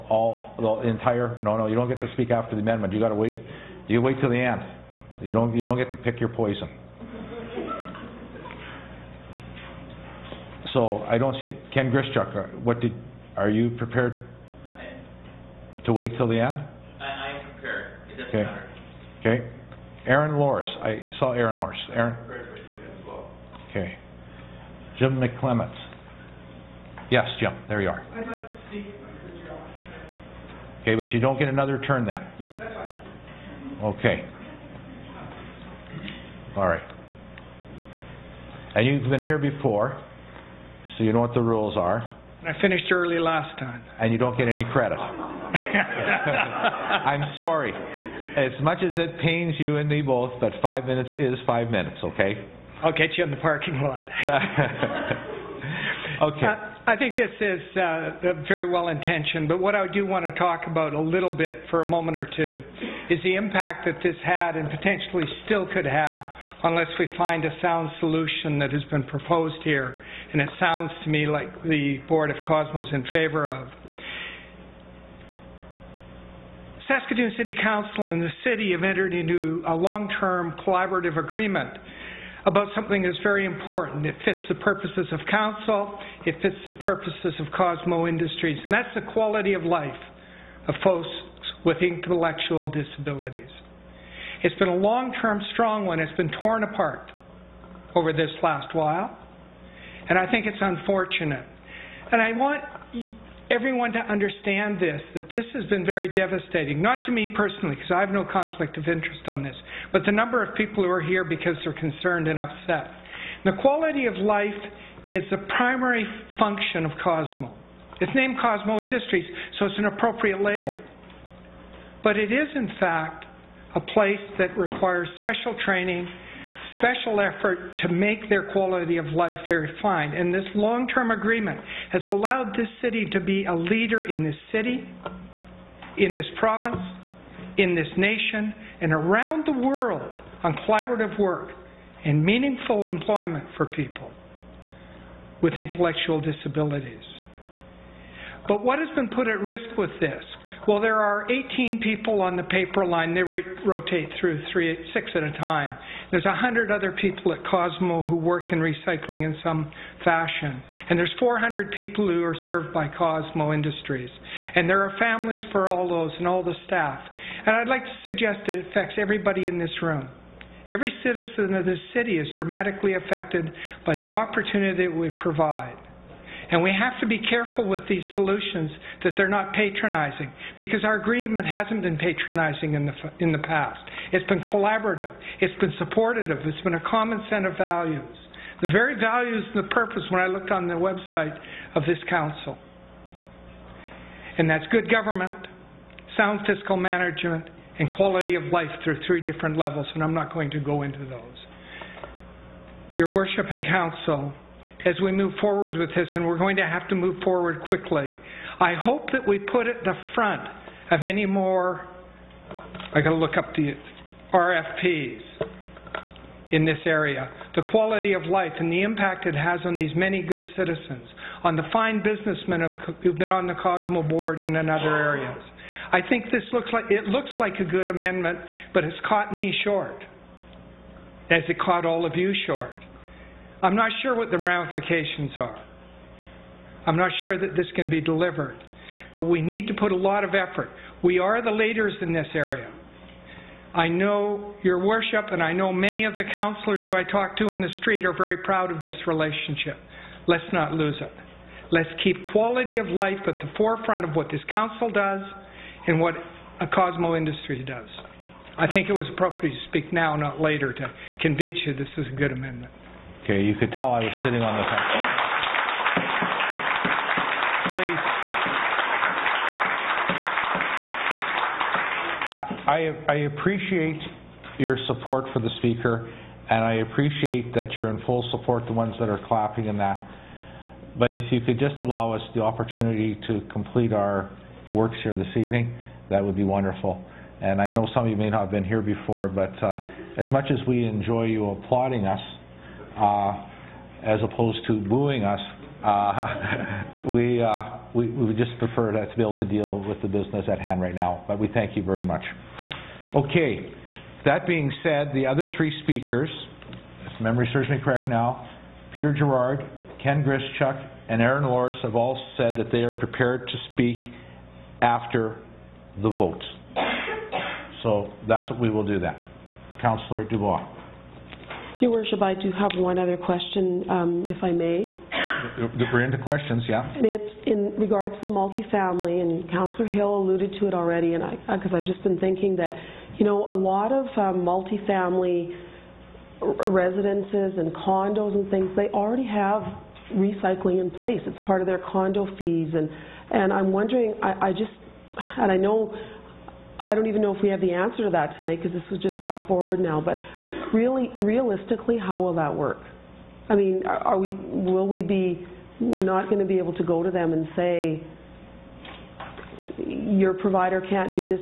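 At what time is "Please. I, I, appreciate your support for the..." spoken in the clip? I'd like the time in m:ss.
4:32.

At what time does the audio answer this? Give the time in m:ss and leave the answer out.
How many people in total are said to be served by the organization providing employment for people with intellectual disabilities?
2:41.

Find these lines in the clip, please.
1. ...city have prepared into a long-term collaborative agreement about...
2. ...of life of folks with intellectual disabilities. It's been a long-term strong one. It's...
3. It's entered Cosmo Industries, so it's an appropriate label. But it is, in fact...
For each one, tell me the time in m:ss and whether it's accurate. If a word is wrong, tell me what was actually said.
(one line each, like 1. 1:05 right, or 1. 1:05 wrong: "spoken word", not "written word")
1. 1:18 wrong: "entered", not "prepared"
2. 1:29 right
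3. 1:58 wrong: "named", not "entered".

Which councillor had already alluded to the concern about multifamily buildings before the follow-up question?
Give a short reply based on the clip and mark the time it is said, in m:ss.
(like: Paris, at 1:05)
Councillor Hill, at 5:29.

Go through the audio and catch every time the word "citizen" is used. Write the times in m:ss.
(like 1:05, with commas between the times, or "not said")
2:51, 3:40.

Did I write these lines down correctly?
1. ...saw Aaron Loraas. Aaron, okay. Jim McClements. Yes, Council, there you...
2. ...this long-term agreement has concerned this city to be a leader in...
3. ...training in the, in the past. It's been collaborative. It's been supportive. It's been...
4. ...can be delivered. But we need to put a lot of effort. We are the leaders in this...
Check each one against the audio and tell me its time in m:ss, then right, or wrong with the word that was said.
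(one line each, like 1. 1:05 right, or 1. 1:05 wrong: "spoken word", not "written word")
1. 0:21 wrong: "Jim", not "Council"
2. 2:10 wrong: "allowed", not "concerned"
3. 3:01 wrong: "patronizing", not "training"
4. 3:57 right.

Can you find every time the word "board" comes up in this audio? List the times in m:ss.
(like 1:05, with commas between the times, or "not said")
1:12, 3:44.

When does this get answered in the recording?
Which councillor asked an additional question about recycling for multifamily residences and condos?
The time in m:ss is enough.
5:19.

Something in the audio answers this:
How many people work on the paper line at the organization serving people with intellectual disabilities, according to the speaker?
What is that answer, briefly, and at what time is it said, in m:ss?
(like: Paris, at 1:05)
18, at 2:31.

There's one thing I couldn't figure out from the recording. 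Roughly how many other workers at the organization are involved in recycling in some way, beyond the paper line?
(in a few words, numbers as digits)
100.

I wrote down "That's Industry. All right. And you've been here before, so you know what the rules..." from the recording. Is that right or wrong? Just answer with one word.
wrong.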